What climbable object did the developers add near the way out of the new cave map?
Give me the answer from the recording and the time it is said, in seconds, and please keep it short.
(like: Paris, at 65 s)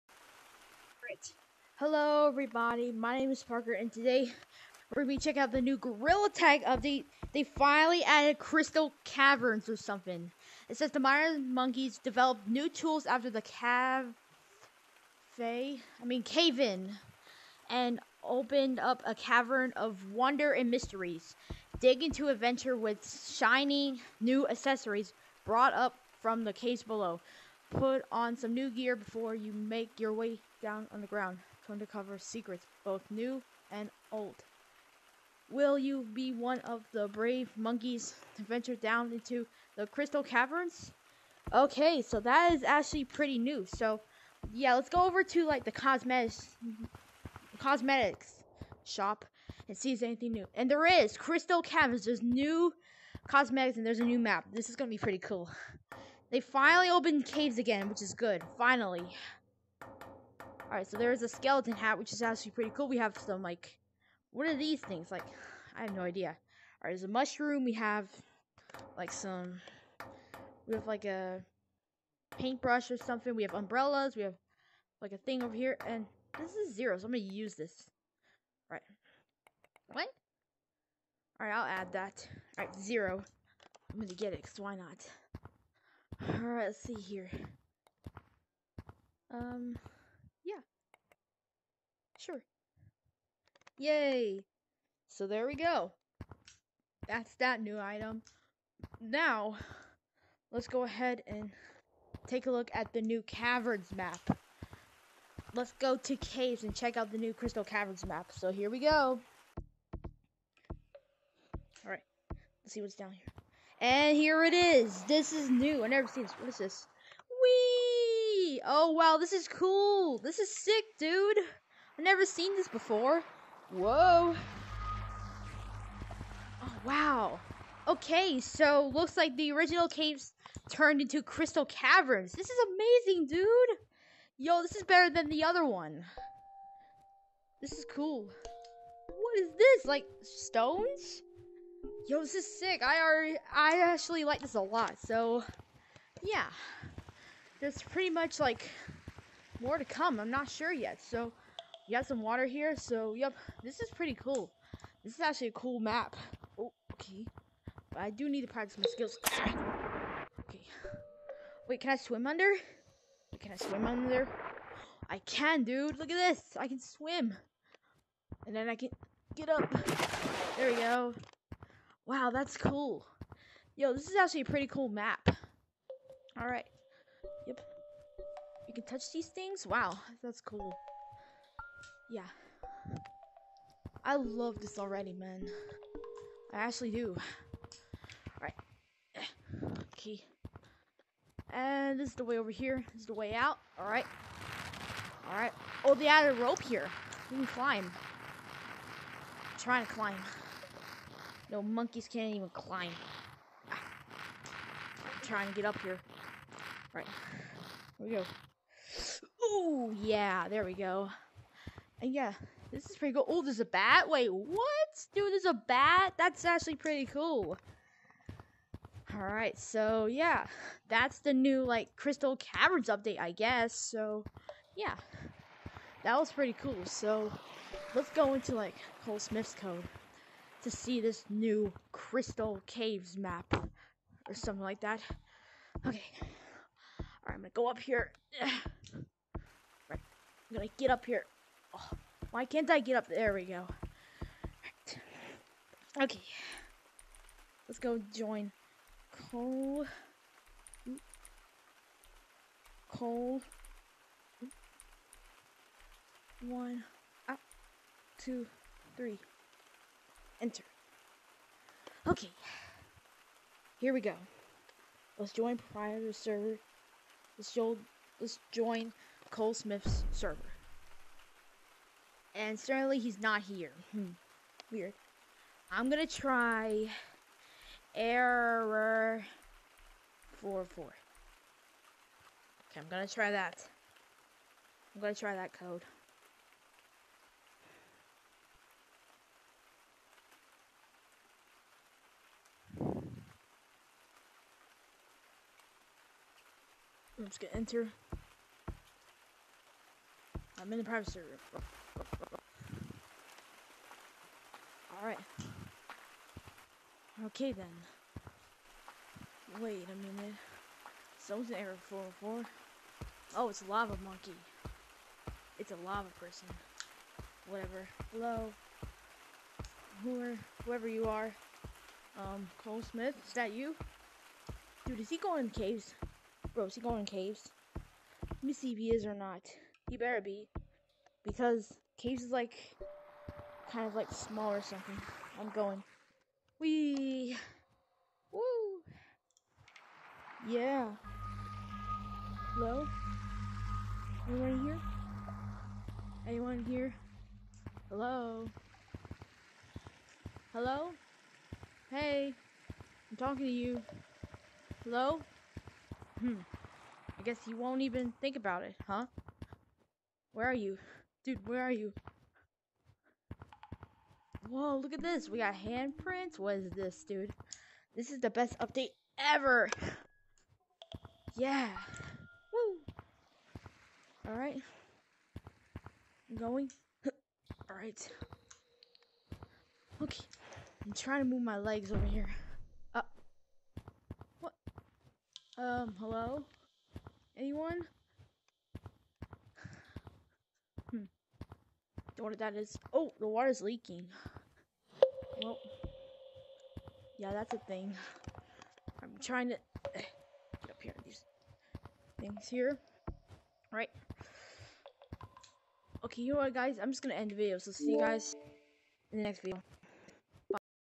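a rope, at 196 s.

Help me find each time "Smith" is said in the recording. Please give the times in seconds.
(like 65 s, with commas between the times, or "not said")
229 s, 269 s, 322 s.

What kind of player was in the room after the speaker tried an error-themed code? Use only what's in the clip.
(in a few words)
a lava monkey.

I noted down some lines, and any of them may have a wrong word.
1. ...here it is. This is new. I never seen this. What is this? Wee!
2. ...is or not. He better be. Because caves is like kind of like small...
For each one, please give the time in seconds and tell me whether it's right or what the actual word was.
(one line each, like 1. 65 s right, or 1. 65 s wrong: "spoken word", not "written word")
1. 114 s right
2. 328 s right.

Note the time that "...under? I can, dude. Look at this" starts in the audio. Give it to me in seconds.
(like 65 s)
163 s.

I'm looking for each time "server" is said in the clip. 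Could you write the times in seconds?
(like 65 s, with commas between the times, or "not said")
266 s, 270 s.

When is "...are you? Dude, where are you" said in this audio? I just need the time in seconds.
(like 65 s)
360 s.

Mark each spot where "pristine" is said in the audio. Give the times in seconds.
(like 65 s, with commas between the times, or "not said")
not said.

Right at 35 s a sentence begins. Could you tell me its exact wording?
Will you be one of the brave monkeys to venture down into the crystal caverns?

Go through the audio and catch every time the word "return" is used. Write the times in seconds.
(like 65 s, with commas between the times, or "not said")
not said.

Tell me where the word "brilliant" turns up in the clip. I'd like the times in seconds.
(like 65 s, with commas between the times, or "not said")
not said.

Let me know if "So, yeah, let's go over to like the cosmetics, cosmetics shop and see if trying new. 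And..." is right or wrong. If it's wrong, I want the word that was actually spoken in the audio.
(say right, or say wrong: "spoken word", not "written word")
wrong: "anything", not "trying".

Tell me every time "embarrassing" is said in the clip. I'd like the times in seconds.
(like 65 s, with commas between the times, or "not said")
not said.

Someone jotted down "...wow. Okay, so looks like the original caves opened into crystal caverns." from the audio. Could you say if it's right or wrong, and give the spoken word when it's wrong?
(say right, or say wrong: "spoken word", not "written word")
wrong: "turned", not "opened".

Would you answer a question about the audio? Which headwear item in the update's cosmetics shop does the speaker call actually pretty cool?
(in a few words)
skeleton hat.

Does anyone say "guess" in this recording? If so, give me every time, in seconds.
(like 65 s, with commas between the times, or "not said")
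223 s, 357 s.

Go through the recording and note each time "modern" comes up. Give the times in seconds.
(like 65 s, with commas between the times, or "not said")
10 s.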